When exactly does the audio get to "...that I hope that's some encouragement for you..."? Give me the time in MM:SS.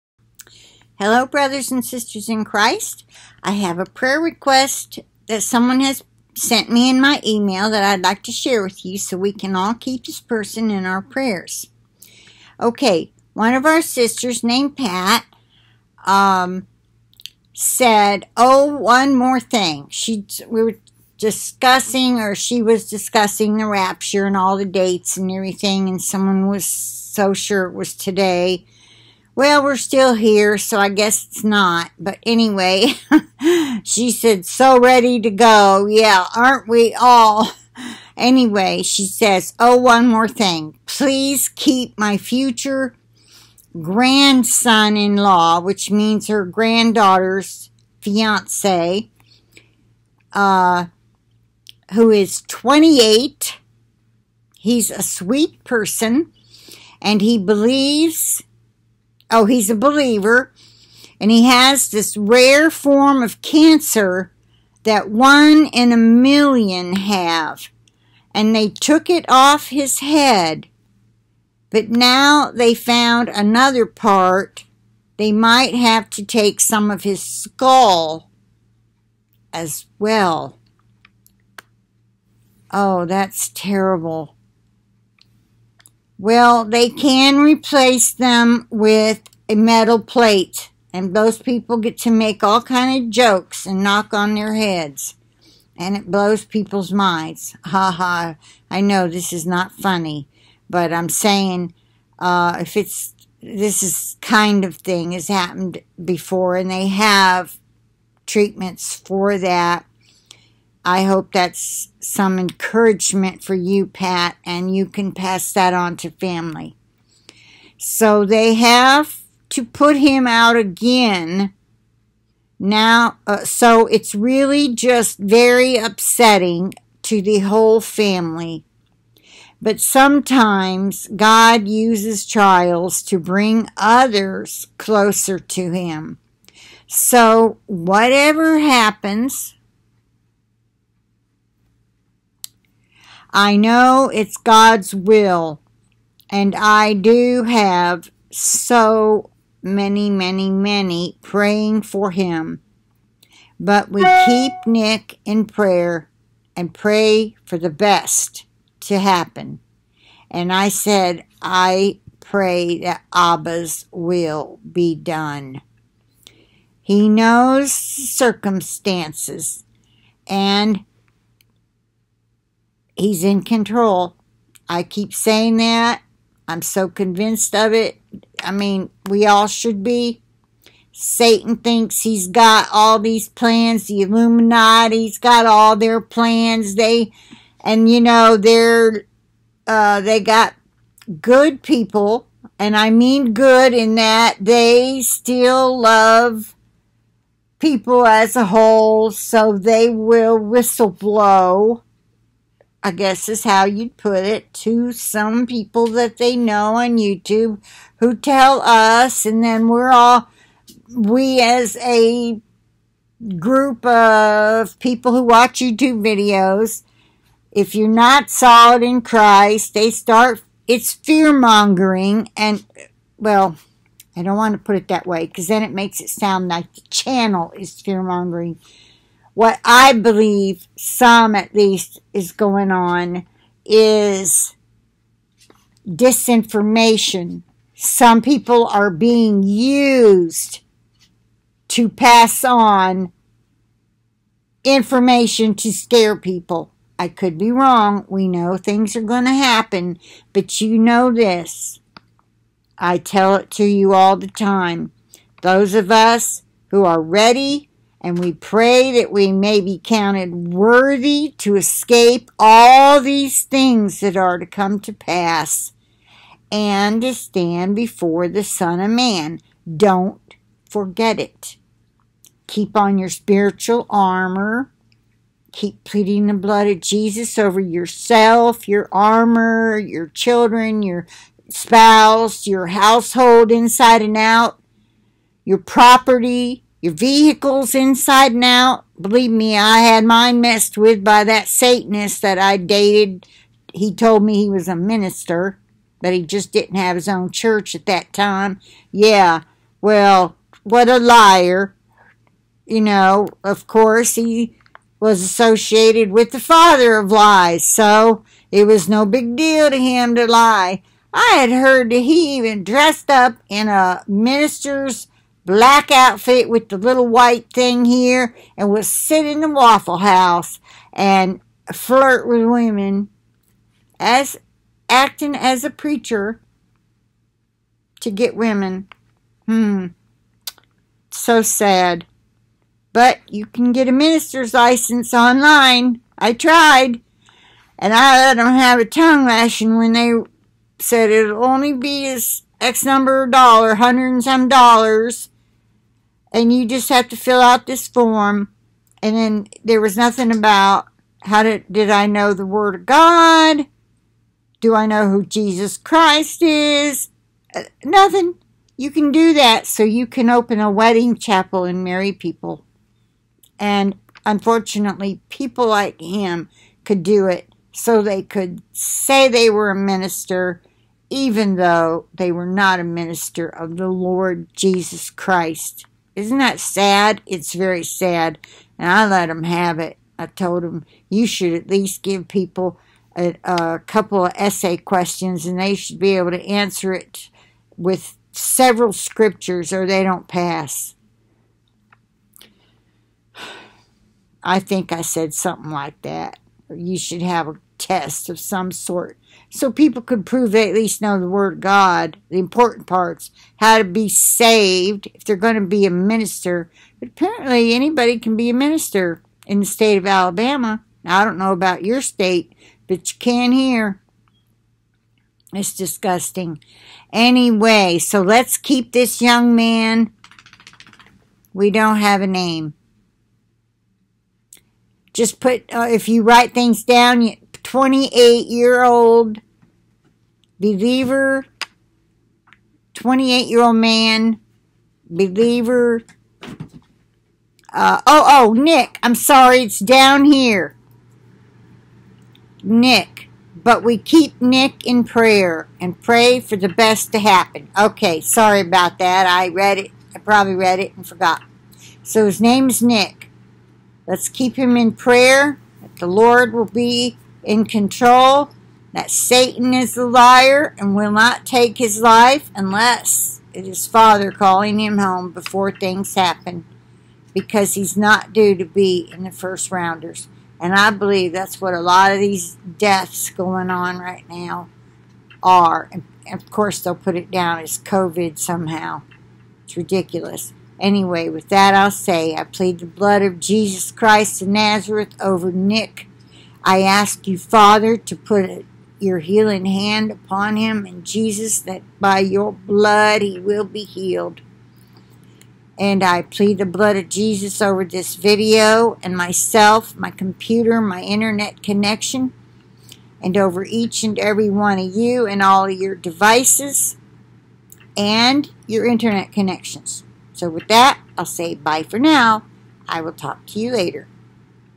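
01:49.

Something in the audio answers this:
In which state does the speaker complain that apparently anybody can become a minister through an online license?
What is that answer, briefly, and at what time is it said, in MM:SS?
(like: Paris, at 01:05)
Alabama, at 06:50.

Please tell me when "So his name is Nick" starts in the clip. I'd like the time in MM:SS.
07:32.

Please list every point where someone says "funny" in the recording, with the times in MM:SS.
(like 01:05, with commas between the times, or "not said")
01:39.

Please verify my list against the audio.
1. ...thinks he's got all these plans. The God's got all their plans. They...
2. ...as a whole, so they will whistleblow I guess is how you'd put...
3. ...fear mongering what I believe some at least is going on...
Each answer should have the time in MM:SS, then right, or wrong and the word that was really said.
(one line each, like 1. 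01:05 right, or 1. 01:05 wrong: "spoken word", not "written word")
1. 03:01 wrong: "Illuminati", not "God"
2. 03:18 right
3. 03:47 right.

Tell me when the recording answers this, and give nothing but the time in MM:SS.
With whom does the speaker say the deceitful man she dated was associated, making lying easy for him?
05:06.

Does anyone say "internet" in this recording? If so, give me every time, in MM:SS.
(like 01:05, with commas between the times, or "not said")
08:21, 08:28.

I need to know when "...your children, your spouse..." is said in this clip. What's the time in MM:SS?
04:39.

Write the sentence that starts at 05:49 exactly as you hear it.
And then there was nothing about how did, did I know the Word of God?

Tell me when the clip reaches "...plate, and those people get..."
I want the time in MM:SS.
01:29.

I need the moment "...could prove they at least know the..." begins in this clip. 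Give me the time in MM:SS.
06:40.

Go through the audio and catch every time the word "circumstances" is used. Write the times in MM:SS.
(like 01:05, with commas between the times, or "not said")
02:47.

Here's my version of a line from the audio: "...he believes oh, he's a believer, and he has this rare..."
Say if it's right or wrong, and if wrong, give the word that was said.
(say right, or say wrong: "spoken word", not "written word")
right.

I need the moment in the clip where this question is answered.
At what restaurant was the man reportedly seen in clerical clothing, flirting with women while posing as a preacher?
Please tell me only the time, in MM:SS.
05:19.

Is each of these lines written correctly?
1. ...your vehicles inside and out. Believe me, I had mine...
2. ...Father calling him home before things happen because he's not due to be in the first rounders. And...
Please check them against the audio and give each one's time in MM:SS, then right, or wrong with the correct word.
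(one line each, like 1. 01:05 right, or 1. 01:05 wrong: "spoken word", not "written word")
1. 04:46 right
2. 07:43 right.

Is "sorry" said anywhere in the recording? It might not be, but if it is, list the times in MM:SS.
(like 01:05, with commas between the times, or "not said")
07:19, 07:28.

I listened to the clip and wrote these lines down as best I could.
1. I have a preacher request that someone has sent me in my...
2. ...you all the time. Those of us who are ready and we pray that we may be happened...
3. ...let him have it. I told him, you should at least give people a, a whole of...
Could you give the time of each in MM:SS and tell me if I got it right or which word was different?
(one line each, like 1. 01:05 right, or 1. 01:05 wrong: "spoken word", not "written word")
1. 00:03 wrong: "prayer", not "preacher"
2. 04:13 wrong: "counted", not "happened"
3. 06:19 wrong: "couple", not "whole".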